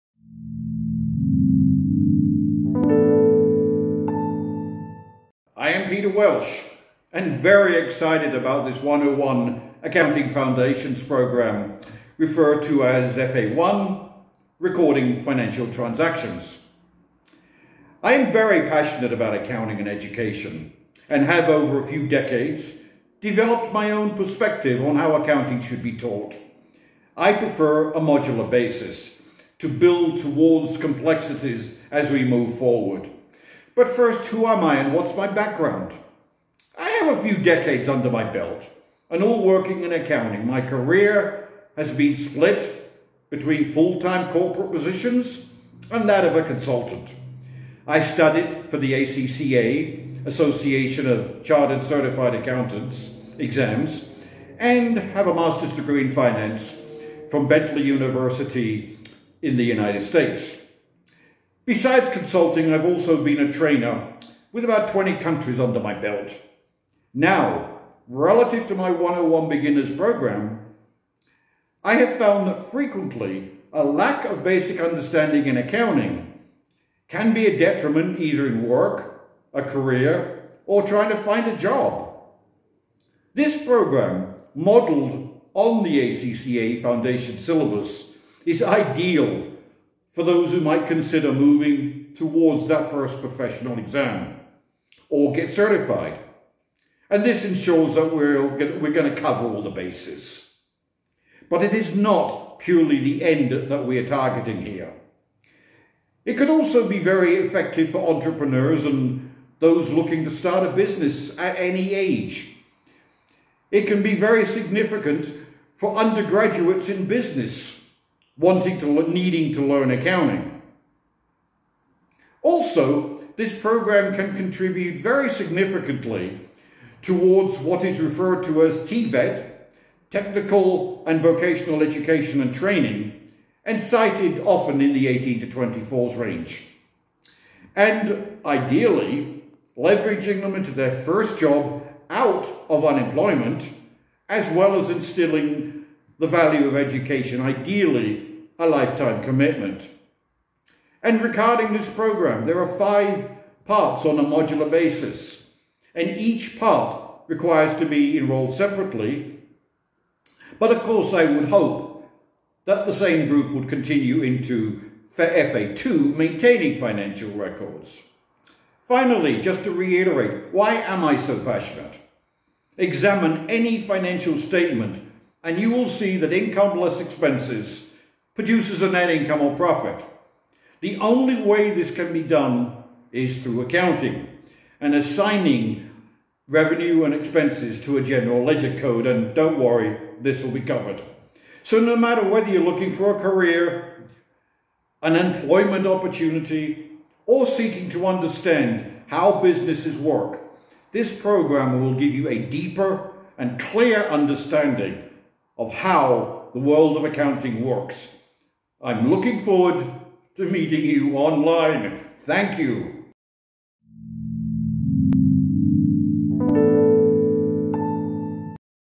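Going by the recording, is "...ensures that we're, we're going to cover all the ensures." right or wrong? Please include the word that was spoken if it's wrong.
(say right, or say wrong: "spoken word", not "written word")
wrong: "bases", not "ensures".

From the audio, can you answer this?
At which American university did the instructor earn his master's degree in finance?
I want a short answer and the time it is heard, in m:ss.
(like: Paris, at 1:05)
Bentley University, at 0:57.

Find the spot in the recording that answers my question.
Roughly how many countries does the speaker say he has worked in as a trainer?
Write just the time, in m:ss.
1:04.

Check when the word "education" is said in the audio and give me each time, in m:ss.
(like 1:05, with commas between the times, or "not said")
0:19, 2:11, 2:26.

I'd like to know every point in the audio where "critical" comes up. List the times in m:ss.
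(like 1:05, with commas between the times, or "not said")
not said.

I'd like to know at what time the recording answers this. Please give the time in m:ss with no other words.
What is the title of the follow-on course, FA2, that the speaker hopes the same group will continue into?
2:46.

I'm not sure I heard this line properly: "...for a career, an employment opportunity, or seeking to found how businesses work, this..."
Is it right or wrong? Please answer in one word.
wrong.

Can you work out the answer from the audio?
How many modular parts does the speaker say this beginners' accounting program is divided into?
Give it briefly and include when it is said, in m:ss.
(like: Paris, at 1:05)
5, at 2:32.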